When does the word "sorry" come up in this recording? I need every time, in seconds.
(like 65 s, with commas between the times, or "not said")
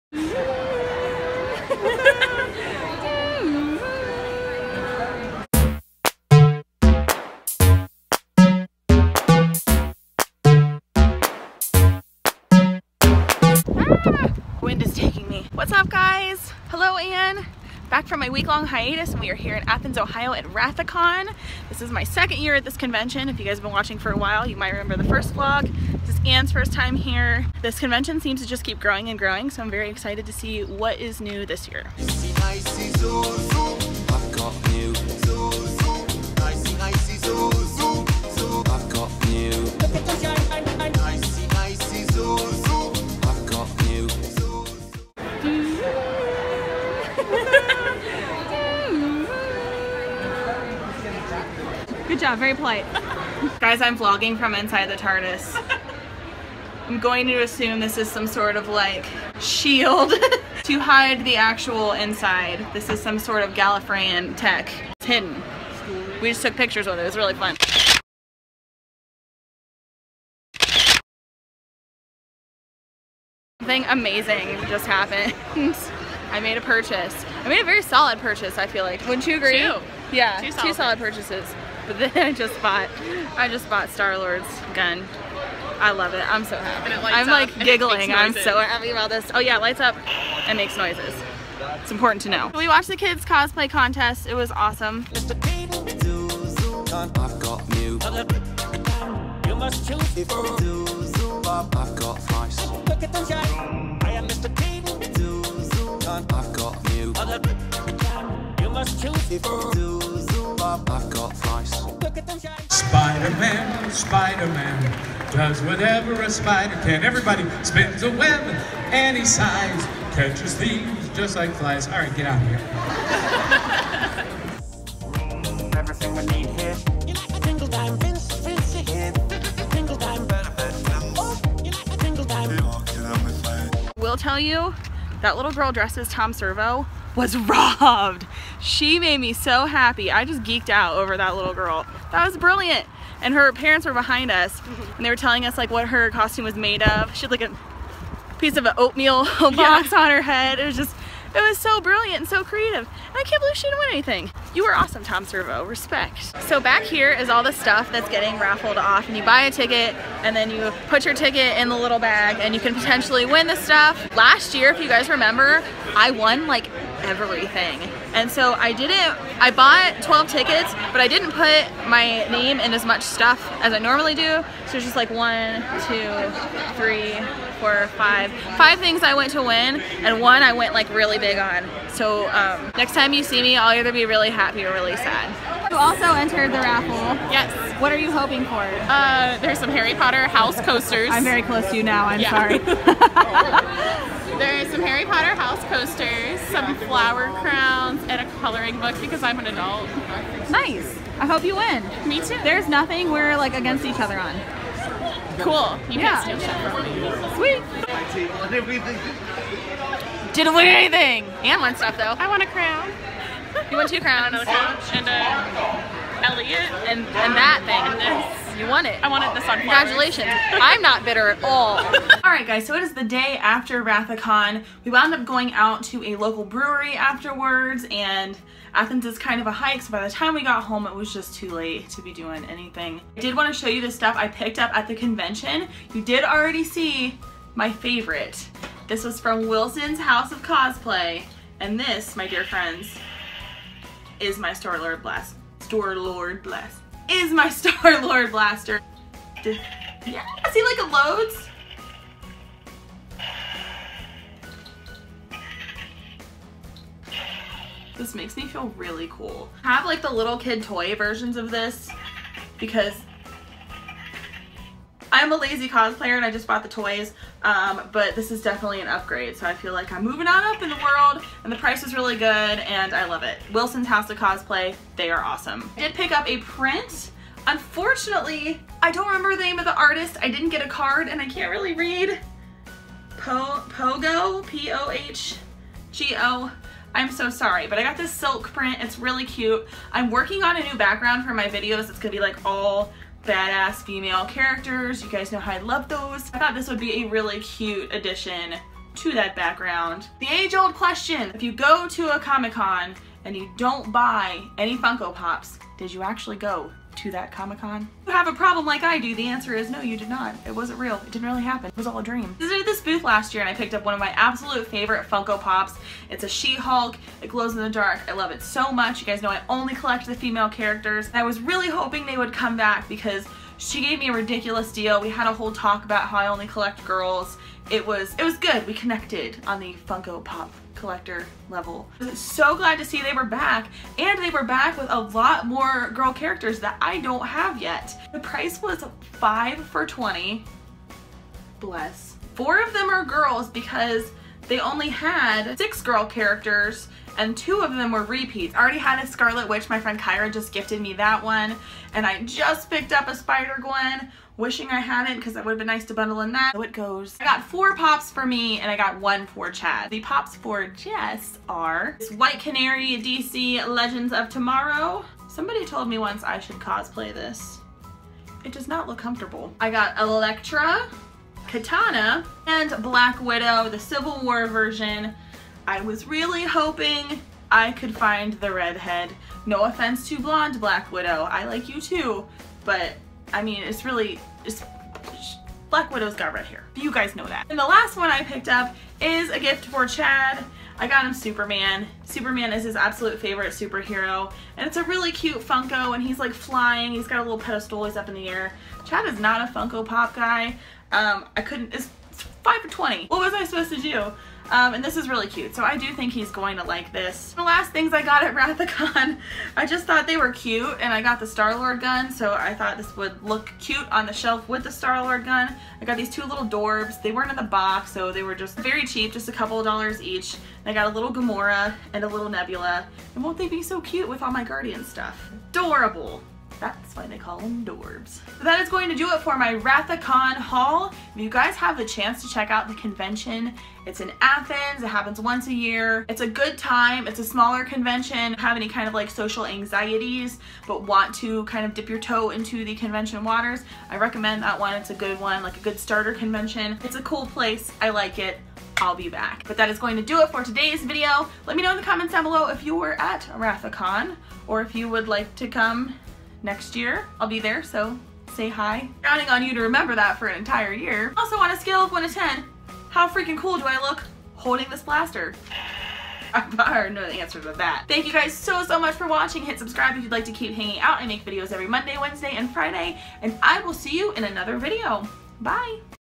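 193 s, 287 s.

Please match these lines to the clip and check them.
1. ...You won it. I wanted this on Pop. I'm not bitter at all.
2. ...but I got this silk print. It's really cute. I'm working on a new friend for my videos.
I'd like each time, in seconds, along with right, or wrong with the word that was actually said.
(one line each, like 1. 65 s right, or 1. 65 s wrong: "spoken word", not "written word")
1. 218 s wrong: "Congratulations", not "Pop"
2. 287 s wrong: "background", not "friend".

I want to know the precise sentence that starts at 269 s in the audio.
So I feel like I'm moving on up in the world and the price is really good and I love it.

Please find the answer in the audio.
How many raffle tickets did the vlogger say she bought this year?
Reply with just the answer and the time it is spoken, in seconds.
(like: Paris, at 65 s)
12, at 170 s.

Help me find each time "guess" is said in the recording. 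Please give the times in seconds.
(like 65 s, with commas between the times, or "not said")
not said.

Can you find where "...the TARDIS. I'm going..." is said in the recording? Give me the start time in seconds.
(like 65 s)
54 s.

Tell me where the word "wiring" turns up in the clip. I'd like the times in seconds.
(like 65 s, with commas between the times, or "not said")
not said.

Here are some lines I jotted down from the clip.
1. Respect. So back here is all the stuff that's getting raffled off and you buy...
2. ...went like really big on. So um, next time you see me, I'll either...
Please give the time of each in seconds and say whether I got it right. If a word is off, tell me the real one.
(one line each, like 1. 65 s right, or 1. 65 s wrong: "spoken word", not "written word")
1. 155 s right
2. 180 s right.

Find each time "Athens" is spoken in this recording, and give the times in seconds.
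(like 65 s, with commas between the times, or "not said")
19 s, 228 s, 434 s.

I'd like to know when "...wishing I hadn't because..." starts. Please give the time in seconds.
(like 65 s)
354 s.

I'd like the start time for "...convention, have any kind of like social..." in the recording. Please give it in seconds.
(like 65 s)
437 s.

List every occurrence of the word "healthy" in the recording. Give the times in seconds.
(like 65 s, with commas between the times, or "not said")
not said.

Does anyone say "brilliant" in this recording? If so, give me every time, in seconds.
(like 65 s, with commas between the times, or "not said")
142 s, 151 s.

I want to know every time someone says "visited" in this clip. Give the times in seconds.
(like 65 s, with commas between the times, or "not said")
312 s.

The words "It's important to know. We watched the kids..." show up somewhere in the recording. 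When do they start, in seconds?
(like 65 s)
91 s.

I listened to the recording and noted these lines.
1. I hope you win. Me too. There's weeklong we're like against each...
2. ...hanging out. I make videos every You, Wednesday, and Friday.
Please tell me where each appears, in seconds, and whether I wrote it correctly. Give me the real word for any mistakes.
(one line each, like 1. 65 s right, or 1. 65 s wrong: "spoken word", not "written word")
1. 201 s wrong: "nothing", not "weeklong"
2. 470 s wrong: "Monday", not "You".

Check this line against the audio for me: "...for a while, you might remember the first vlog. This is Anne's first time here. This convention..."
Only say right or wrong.
right.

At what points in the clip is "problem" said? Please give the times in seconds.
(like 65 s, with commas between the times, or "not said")
308 s.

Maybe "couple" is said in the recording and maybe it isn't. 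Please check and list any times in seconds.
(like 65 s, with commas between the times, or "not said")
419 s.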